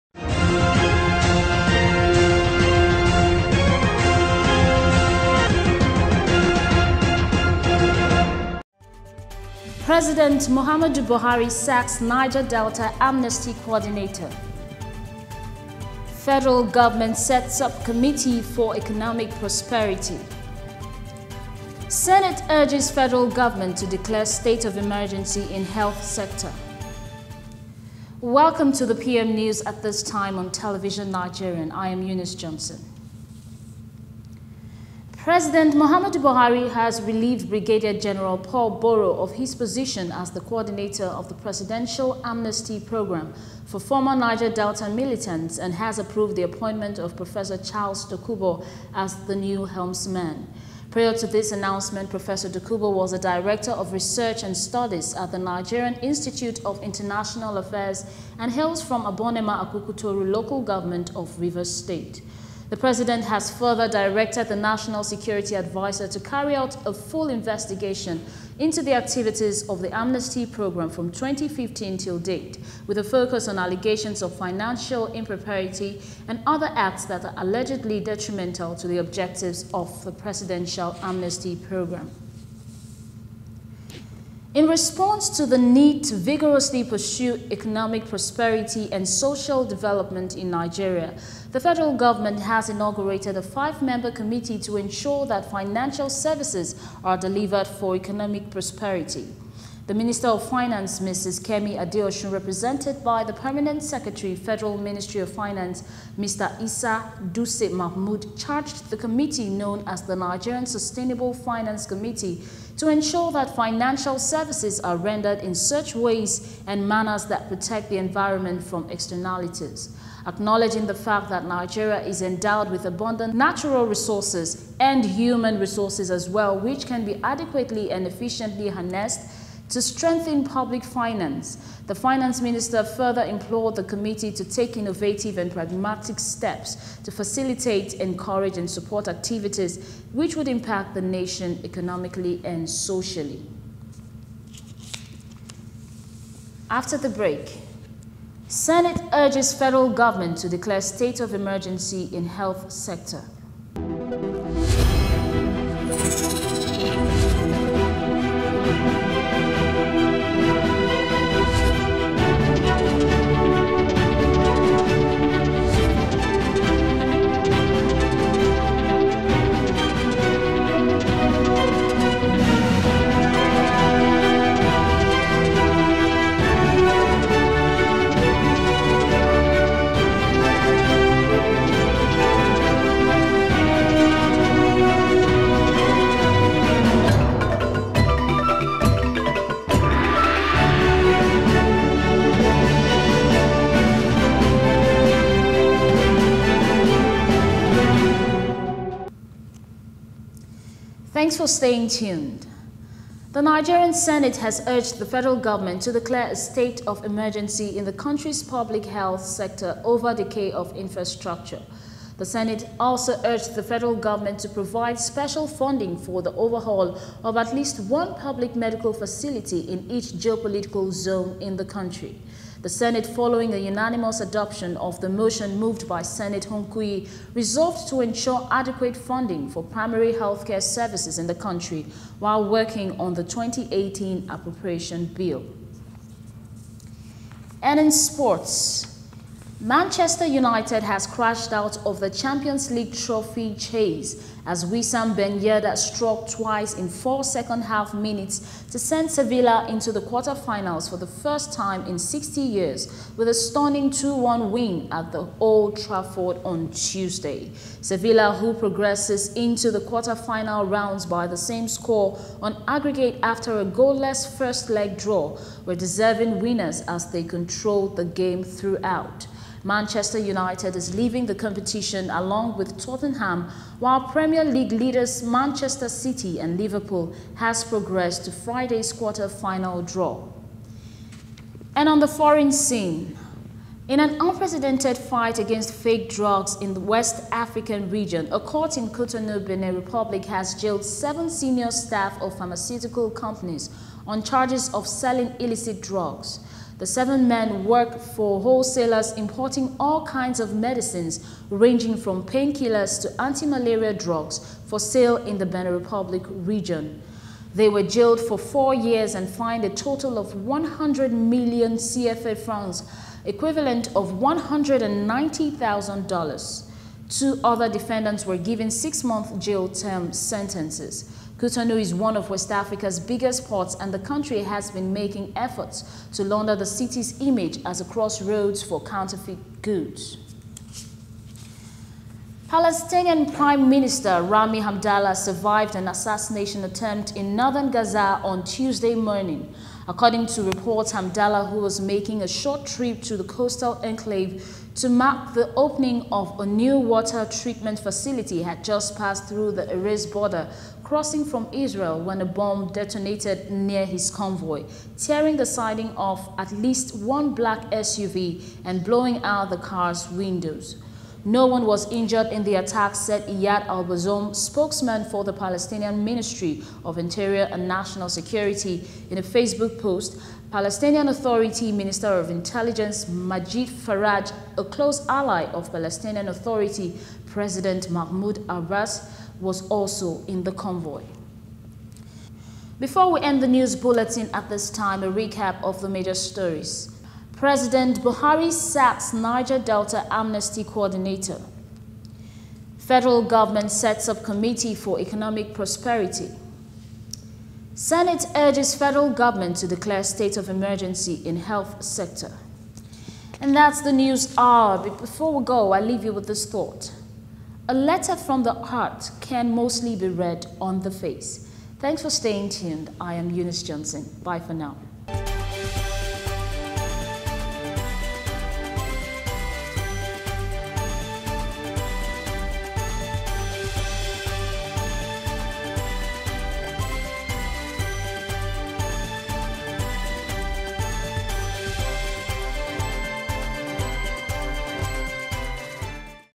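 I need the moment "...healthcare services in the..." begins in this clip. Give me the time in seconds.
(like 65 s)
230 s.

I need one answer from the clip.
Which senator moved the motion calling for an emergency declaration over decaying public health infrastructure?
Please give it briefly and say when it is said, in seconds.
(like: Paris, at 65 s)
Hunkuyi, at 226 s.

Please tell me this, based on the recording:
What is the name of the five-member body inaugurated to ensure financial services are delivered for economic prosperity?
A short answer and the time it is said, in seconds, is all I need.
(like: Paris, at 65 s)
Nigerian Sustainable Finance Committee, at 110 s.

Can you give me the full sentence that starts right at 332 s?
Palestinian Prime Minister Rami Hamdallah survived an assassination attempt in northern Gaza on Tuesday morning.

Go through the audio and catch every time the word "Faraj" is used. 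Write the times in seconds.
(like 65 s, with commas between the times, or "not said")
373 s.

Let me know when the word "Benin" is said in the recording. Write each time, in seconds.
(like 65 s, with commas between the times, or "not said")
289 s, 305 s.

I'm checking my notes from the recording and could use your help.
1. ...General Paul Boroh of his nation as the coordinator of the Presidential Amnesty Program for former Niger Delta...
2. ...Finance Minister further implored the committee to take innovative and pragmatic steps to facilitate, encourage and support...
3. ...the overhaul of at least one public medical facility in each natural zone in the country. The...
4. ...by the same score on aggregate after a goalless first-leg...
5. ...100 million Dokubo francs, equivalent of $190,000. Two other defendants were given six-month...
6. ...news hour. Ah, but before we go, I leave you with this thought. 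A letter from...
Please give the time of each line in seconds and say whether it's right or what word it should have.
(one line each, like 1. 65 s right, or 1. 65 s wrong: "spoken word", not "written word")
1. 37 s wrong: "position", not "nation"
2. 131 s right
3. 216 s wrong: "geopolitical", not "natural"
4. 261 s right
5. 310 s wrong: "CFA", not "Dokubo"
6. 403 s right.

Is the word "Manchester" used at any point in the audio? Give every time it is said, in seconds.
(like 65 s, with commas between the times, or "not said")
239 s, 269 s, 275 s.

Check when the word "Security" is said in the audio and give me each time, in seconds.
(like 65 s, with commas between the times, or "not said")
65 s, 368 s.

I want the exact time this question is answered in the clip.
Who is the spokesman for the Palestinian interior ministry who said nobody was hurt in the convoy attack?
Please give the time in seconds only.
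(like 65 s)
363 s.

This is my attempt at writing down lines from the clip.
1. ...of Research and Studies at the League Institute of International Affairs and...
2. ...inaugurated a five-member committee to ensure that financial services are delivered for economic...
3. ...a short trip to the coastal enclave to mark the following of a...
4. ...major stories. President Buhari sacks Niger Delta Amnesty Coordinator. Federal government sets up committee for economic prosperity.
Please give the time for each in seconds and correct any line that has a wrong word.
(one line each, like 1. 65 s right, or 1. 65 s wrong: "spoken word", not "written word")
1. 53 s wrong: "Nigerian", not "League"
2. 92 s right
3. 342 s wrong: "opening", not "following"
4. 385 s right.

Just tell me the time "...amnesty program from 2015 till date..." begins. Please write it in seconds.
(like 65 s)
69 s.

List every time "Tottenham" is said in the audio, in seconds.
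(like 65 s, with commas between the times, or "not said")
272 s.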